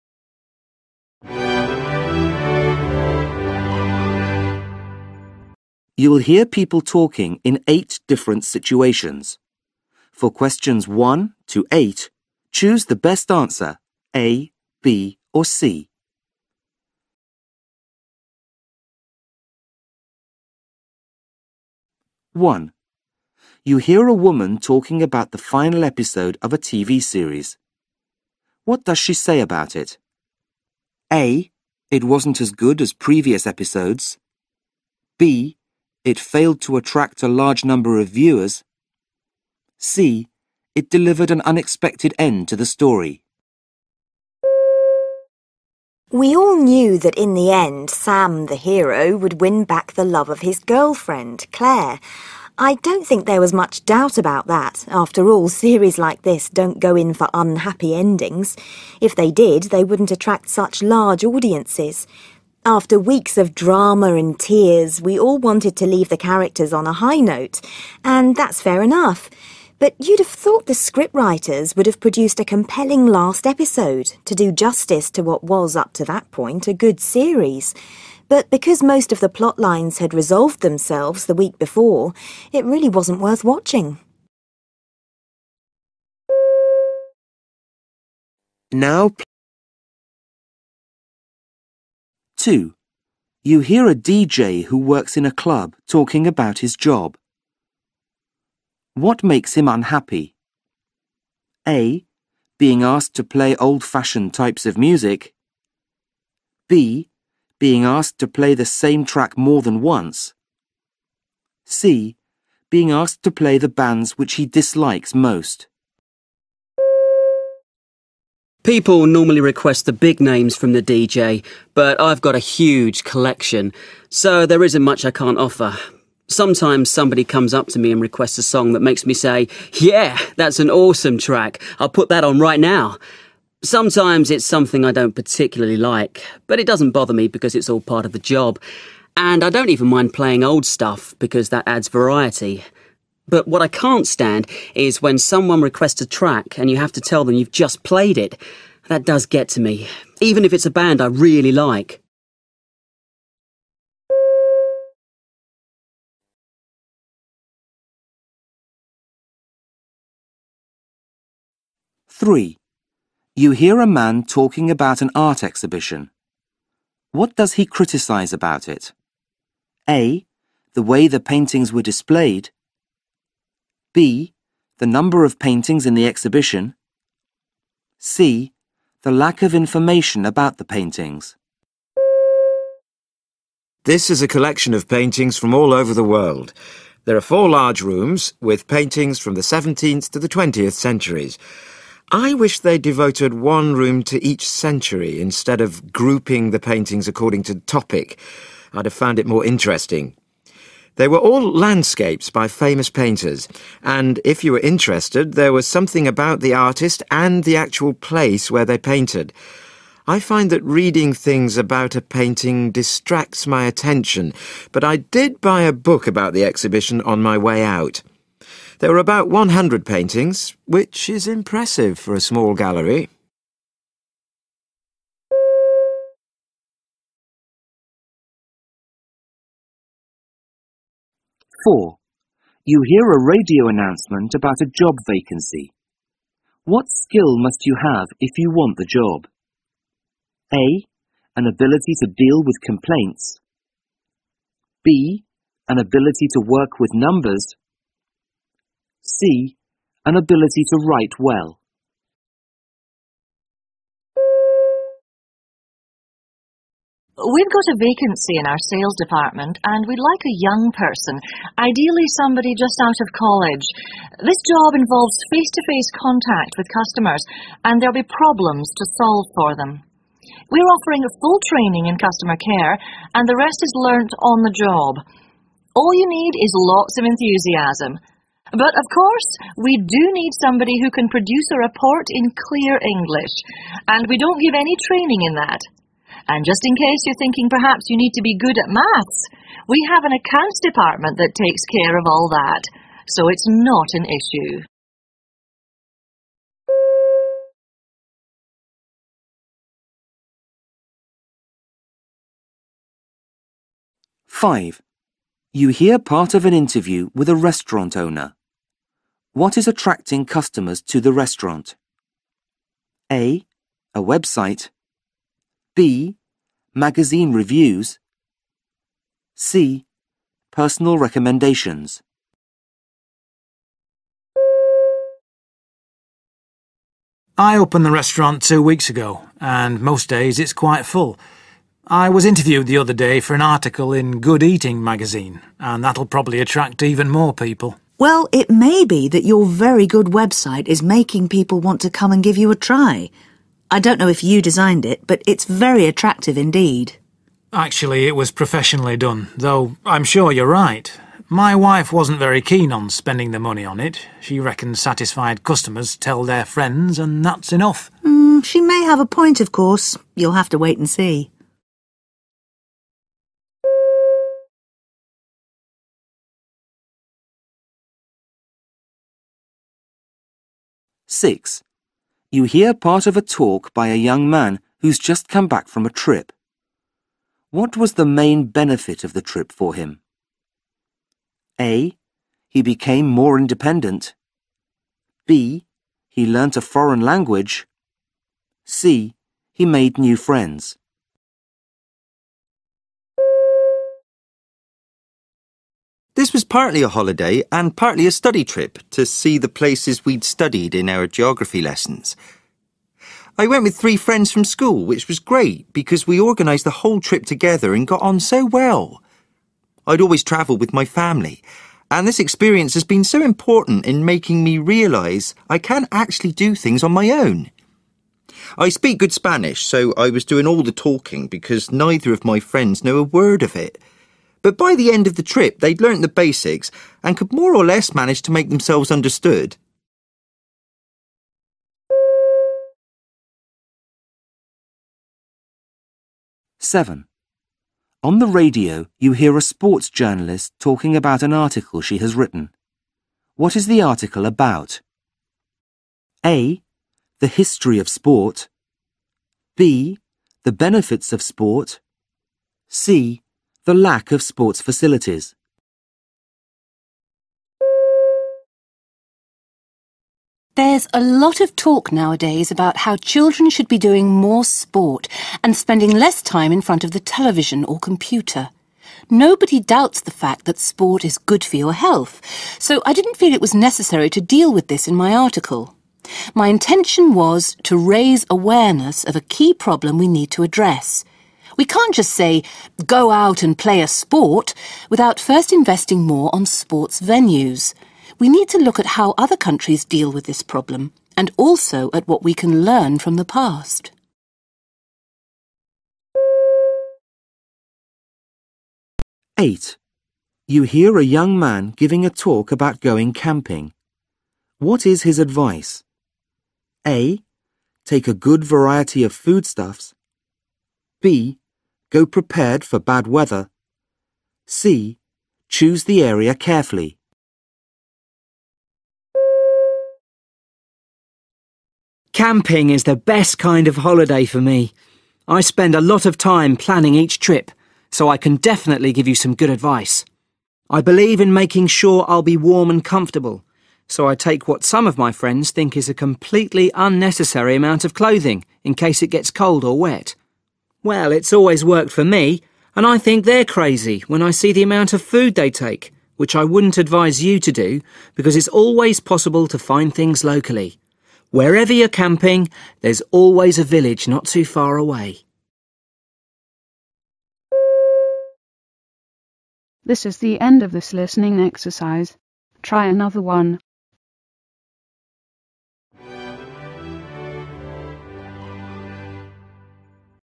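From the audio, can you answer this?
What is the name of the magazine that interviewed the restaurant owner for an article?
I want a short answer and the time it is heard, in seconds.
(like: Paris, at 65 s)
Good Eating, at 334 s.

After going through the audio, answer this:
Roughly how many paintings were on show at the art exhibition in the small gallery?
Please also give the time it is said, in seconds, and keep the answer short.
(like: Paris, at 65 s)
100, at 219 s.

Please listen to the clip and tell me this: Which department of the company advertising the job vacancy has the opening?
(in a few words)
Sales.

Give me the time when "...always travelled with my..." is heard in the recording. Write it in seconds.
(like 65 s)
409 s.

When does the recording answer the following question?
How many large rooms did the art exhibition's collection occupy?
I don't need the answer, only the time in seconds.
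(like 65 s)
187 s.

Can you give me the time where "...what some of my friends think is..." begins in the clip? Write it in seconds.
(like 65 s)
534 s.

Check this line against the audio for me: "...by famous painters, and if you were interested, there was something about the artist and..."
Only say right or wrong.
right.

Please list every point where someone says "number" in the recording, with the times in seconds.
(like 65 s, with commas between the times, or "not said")
37 s, 174 s, 246 s.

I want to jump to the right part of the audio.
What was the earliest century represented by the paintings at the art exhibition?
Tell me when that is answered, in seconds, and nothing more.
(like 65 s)
189 s.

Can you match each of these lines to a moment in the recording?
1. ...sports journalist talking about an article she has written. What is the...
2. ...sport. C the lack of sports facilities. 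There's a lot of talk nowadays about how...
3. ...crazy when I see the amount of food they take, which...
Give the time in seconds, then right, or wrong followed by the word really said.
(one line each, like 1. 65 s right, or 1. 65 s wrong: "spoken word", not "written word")
1. 439 s right
2. 451 s right
3. 543 s right.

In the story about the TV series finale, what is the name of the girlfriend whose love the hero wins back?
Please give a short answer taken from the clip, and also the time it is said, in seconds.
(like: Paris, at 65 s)
Claire, at 51 s.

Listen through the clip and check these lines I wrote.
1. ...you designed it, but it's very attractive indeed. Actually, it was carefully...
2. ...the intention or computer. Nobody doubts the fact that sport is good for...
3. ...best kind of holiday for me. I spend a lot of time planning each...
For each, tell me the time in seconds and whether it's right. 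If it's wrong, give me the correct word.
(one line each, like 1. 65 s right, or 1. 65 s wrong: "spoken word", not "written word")
1. 344 s wrong: "professionally", not "carefully"
2. 466 s wrong: "television", not "intention"
3. 522 s right.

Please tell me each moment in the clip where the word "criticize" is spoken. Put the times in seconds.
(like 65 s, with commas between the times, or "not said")
167 s.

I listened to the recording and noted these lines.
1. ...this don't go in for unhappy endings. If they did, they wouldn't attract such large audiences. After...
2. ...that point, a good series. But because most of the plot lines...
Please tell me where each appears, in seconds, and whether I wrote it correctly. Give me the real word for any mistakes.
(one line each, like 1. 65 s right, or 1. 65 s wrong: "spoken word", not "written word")
1. 56 s right
2. 76 s right.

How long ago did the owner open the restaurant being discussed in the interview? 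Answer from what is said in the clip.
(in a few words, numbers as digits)
Two weeks.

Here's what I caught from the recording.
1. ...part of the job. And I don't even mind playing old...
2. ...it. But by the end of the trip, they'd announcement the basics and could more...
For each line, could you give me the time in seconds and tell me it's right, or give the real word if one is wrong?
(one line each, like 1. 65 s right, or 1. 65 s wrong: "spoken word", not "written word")
1. 137 s right
2. 423 s wrong: "learnt", not "announcement".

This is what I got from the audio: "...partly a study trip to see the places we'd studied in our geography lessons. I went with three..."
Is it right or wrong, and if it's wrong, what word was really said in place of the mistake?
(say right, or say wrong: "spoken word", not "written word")
right.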